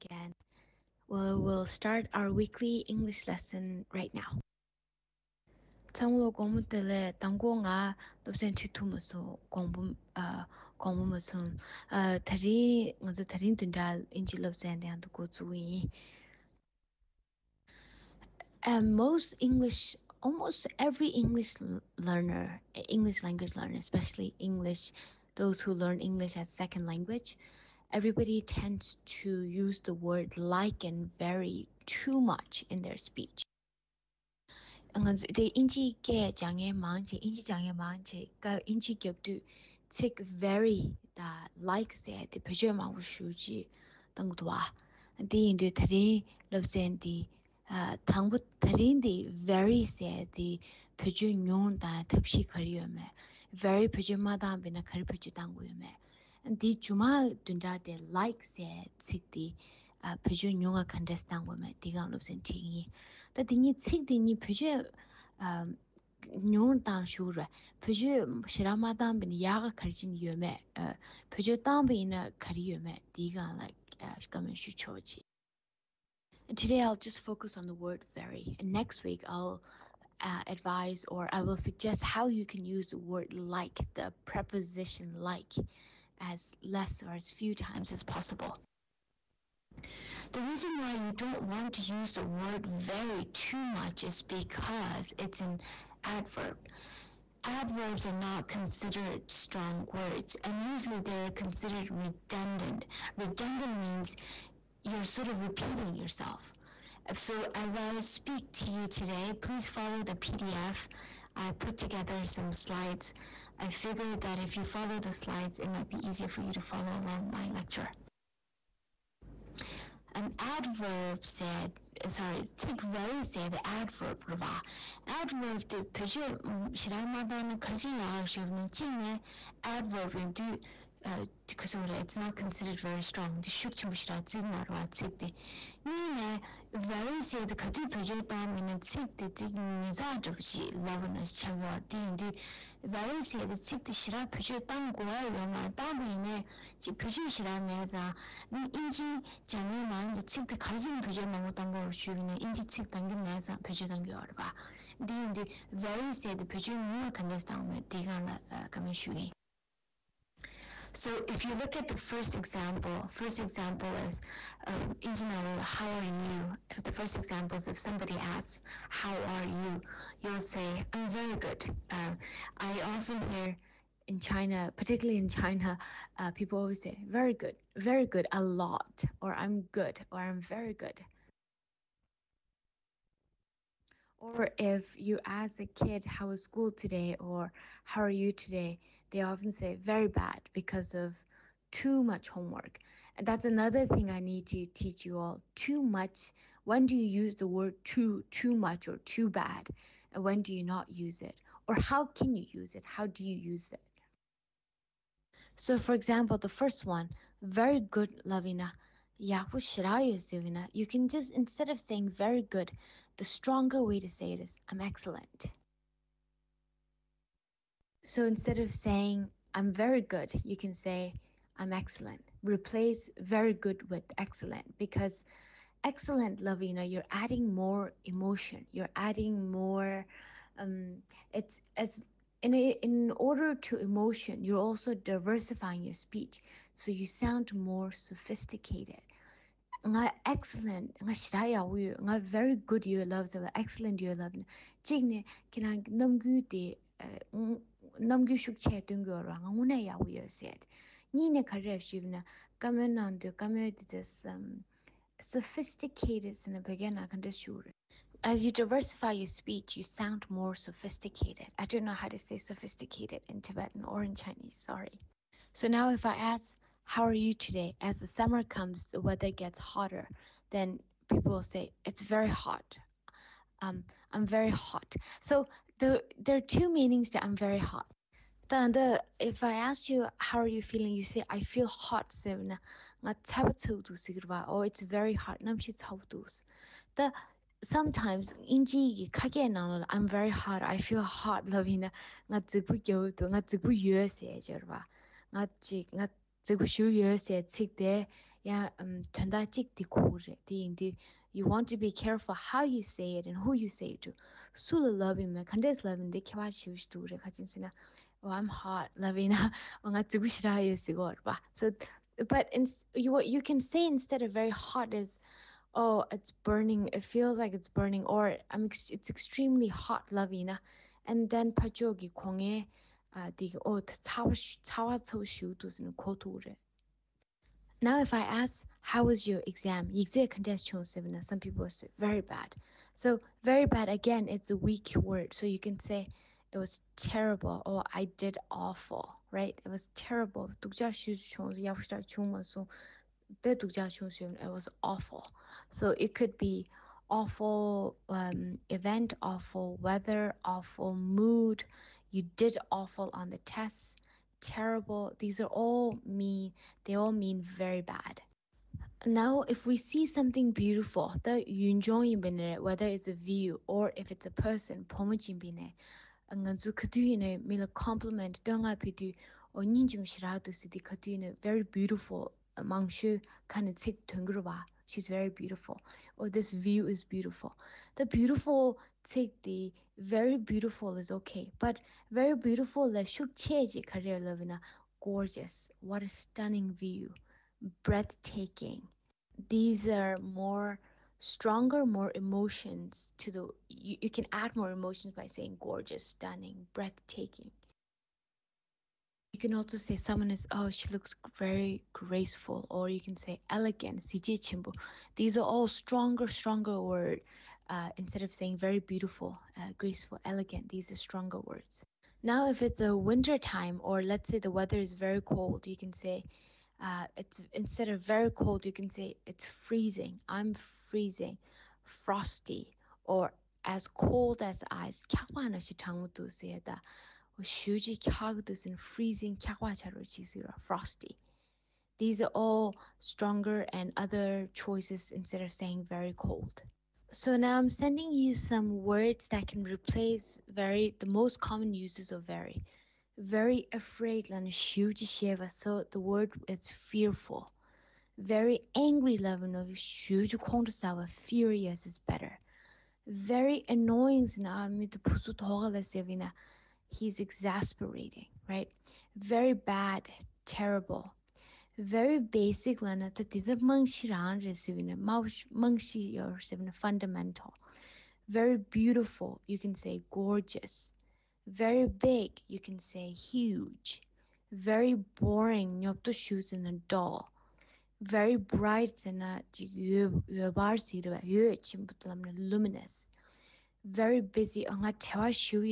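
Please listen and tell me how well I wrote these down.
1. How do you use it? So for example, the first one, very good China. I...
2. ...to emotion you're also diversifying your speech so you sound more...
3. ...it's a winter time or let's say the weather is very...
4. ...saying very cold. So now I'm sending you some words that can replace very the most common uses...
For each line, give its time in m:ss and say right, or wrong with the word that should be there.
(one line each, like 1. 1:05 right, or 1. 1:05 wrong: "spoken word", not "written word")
1. 3:22 wrong: "Lavina", not "China"
2. 3:53 right
3. 6:52 right
4. 7:15 right.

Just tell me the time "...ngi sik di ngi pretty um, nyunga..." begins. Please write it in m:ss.
1:03.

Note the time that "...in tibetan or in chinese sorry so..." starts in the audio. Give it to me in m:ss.
4:23.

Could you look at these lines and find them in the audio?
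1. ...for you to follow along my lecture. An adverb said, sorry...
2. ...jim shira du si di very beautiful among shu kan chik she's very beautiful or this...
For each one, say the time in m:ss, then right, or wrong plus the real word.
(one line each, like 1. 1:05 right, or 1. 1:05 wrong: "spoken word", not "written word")
1. 1:56 right
2. 6:09 right.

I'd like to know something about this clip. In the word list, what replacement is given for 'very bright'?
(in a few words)
luminous.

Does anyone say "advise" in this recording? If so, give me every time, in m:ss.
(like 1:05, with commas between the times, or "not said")
1:20.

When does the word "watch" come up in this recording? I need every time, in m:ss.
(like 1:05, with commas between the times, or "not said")
not said.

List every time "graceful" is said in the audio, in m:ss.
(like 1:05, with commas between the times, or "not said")
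6:41, 6:49.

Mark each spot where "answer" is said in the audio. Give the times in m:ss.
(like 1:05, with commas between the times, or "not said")
not said.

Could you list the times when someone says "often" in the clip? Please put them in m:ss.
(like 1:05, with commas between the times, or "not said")
2:52, 3:09.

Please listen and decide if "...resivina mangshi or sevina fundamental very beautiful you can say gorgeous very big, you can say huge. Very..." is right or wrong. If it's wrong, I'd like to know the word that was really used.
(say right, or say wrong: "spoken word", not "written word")
right.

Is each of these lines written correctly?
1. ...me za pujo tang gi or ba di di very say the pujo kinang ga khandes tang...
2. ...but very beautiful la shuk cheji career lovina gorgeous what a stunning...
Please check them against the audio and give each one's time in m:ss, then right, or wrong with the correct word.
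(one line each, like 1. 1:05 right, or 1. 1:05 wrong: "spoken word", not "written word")
1. 2:33 wrong: "nyung", not "kinang"
2. 6:21 right.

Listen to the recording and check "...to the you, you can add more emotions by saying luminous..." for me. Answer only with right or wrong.
wrong.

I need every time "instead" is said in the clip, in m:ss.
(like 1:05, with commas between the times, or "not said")
3:31, 3:38, 5:13, 6:47, 6:57, 7:15.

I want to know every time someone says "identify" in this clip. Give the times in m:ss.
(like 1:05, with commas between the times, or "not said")
not said.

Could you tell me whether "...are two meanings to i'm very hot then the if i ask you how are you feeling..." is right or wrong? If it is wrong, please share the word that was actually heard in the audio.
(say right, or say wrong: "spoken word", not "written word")
right.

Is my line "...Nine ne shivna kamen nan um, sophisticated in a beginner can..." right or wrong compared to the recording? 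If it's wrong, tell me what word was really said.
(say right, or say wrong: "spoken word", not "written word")
right.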